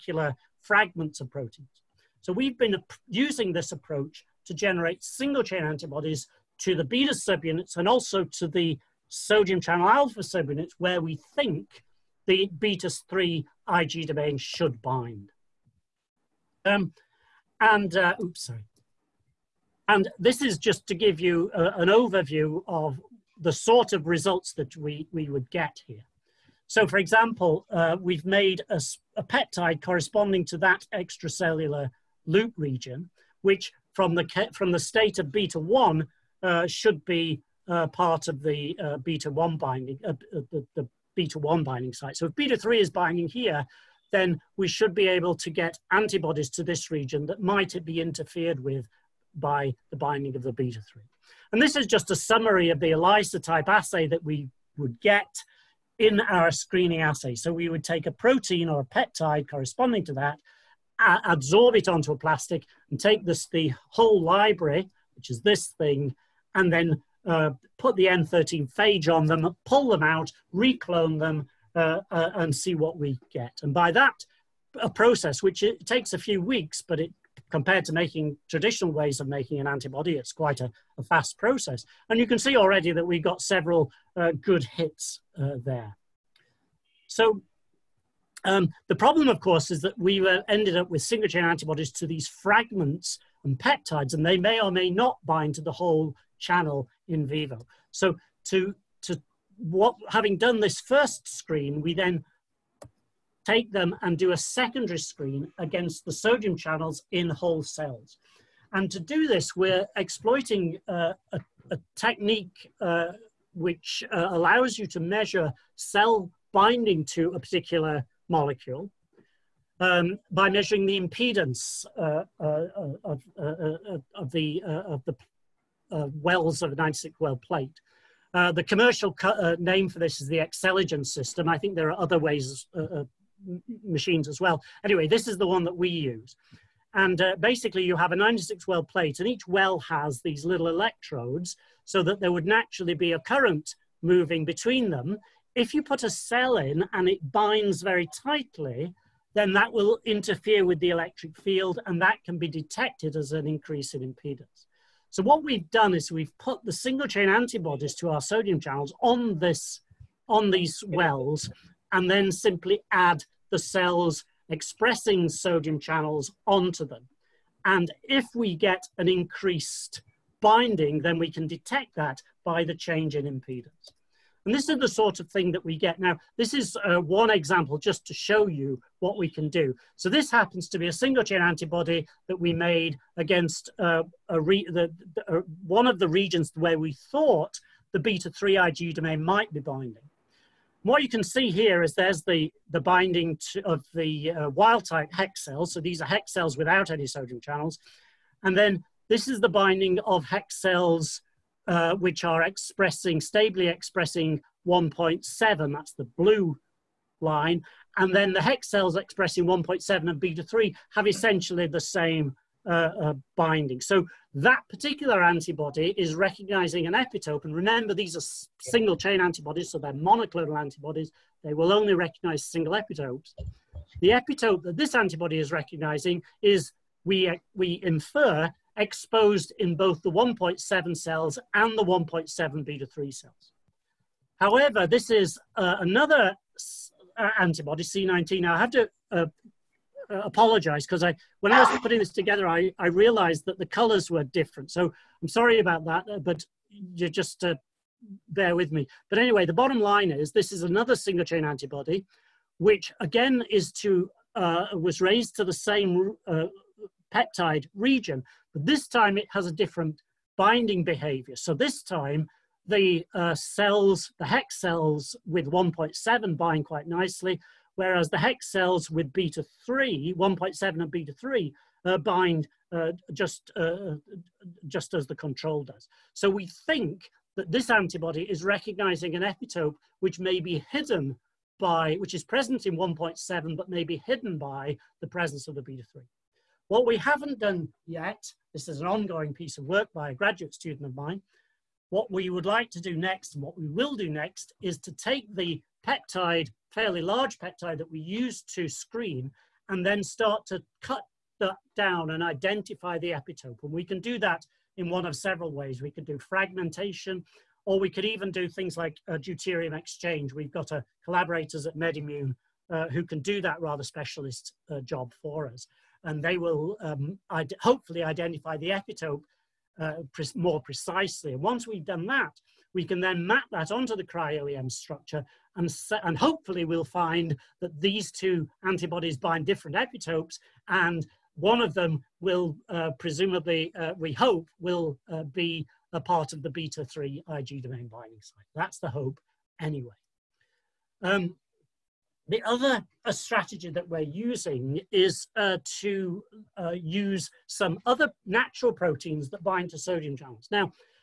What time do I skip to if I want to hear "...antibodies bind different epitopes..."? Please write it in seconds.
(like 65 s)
328 s.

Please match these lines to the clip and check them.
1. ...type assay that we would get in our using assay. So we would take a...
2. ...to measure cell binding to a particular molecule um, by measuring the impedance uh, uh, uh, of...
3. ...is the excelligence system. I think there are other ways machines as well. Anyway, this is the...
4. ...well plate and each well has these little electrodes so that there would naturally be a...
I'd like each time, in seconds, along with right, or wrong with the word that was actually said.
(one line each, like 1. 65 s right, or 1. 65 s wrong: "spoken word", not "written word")
1. 53 s wrong: "screening", not "using"
2. 114 s right
3. 130 s right
4. 138 s right.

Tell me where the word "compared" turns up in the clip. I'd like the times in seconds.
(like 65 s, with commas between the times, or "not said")
77 s.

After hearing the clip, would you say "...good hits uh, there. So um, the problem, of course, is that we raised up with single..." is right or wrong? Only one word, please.
wrong.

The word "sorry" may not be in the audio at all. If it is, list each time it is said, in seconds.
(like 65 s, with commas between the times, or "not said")
18 s, 245 s.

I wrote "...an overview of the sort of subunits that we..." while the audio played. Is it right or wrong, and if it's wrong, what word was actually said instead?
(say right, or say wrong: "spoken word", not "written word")
wrong: "results", not "subunits".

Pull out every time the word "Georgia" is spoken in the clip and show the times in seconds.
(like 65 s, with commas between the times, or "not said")
not said.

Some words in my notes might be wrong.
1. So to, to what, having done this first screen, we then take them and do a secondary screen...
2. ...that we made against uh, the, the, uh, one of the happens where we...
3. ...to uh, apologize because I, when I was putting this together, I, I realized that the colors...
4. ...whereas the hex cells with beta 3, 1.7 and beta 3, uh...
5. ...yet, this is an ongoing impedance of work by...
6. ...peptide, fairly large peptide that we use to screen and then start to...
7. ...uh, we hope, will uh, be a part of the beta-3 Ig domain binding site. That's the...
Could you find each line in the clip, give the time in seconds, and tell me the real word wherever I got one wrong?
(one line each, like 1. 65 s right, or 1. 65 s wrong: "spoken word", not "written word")
1. 97 s right
2. 182 s wrong: "regions", not "happens"
3. 238 s right
4. 267 s right
5. 287 s wrong: "piece", not "impedance"
6. 295 s right
7. 333 s right.